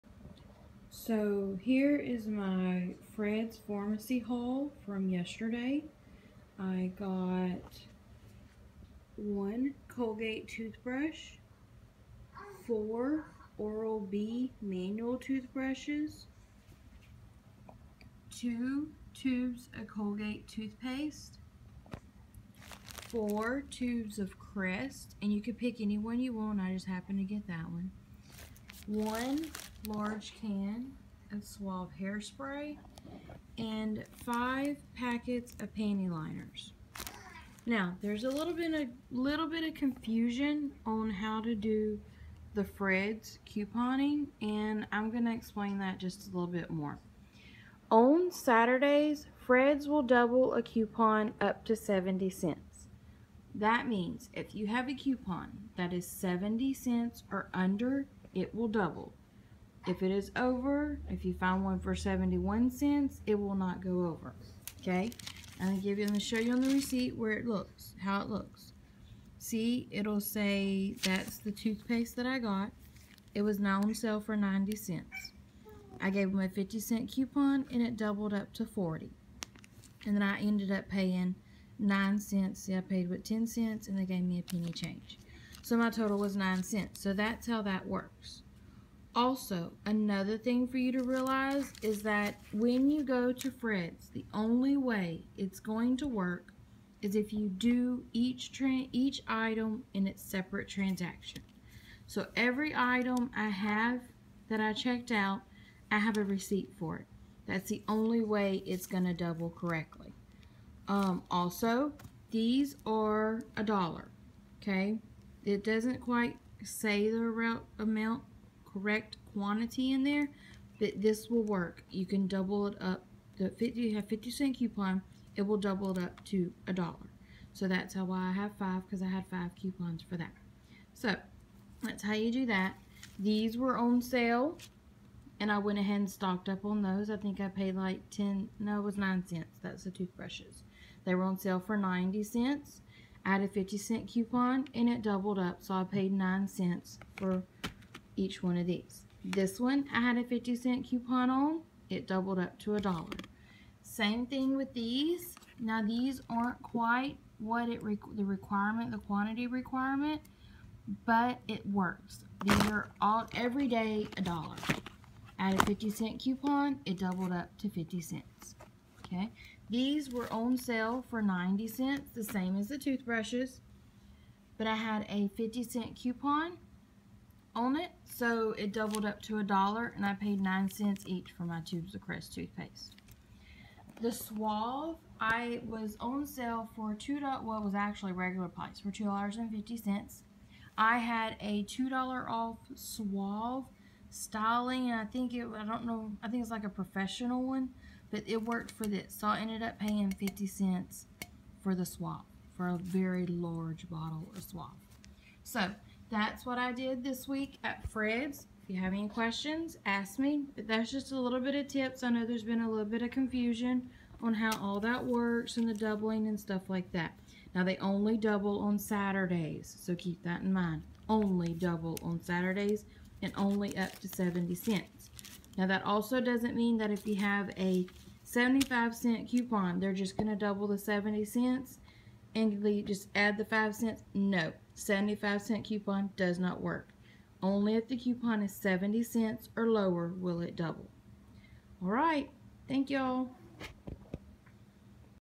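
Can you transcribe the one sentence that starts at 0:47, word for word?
On Saturdays, Fred's will double a coupon up to 70 cents.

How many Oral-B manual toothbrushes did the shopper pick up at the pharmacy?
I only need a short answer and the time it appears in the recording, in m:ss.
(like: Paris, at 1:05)
4, at 0:12.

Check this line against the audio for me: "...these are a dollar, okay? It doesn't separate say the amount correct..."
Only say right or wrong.
wrong.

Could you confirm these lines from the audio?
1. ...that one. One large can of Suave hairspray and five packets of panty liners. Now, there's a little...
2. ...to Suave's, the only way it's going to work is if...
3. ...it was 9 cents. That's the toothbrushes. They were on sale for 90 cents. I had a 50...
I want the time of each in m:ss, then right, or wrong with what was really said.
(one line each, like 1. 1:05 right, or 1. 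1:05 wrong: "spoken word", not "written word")
1. 0:27 right
2. 1:33 wrong: "Fred", not "Suave"
3. 2:18 right.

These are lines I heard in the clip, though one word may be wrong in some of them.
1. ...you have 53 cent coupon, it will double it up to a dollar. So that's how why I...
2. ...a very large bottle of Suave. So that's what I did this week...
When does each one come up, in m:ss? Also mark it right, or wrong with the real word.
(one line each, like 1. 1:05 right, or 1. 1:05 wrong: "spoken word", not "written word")
1. 2:03 wrong: "50", not "53"
2. 3:22 right.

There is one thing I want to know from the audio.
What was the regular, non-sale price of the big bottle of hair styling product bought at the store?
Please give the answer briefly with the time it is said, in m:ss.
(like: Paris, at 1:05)
$2.50, at 3:08.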